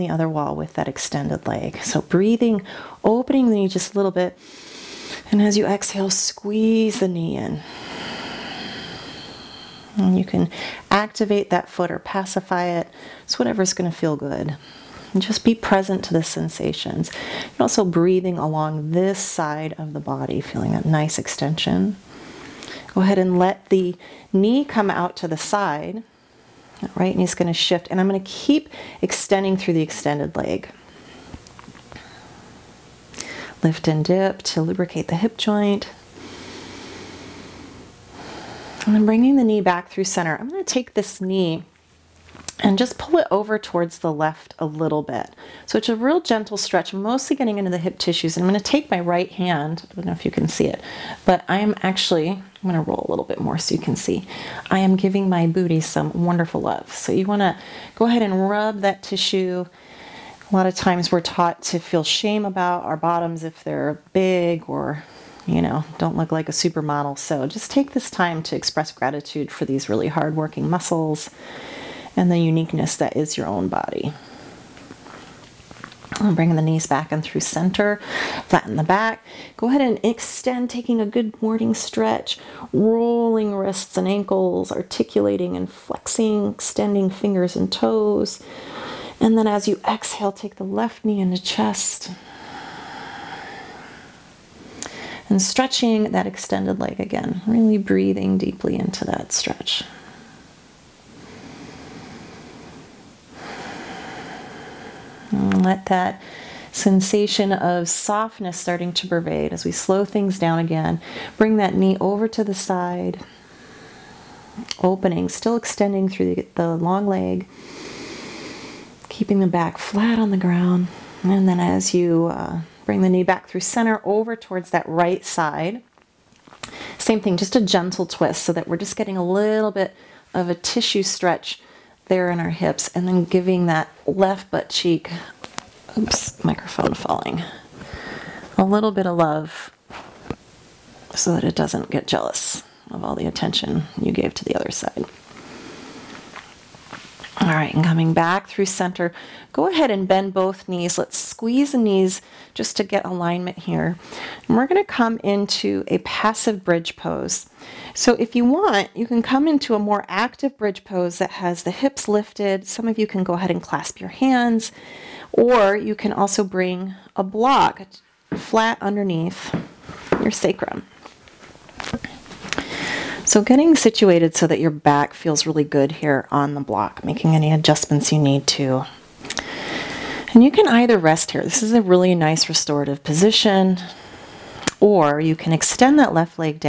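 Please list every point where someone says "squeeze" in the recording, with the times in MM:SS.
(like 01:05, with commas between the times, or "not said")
00:06, 02:31.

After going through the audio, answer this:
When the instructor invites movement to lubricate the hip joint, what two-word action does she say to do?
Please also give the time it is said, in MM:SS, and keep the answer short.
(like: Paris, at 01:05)
Lift and dip, at 00:33.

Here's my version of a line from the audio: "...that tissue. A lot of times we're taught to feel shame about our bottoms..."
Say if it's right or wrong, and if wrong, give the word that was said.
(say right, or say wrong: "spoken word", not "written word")
right.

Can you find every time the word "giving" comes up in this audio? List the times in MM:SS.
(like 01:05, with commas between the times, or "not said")
00:54, 02:13.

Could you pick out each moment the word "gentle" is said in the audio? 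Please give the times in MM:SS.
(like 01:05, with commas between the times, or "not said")
00:46, 02:07.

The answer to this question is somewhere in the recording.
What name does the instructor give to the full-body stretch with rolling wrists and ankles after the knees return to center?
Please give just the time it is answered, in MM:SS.
01:21.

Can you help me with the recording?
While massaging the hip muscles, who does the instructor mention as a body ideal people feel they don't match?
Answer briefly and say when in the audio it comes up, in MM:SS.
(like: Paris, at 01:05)
a supermodel, at 01:06.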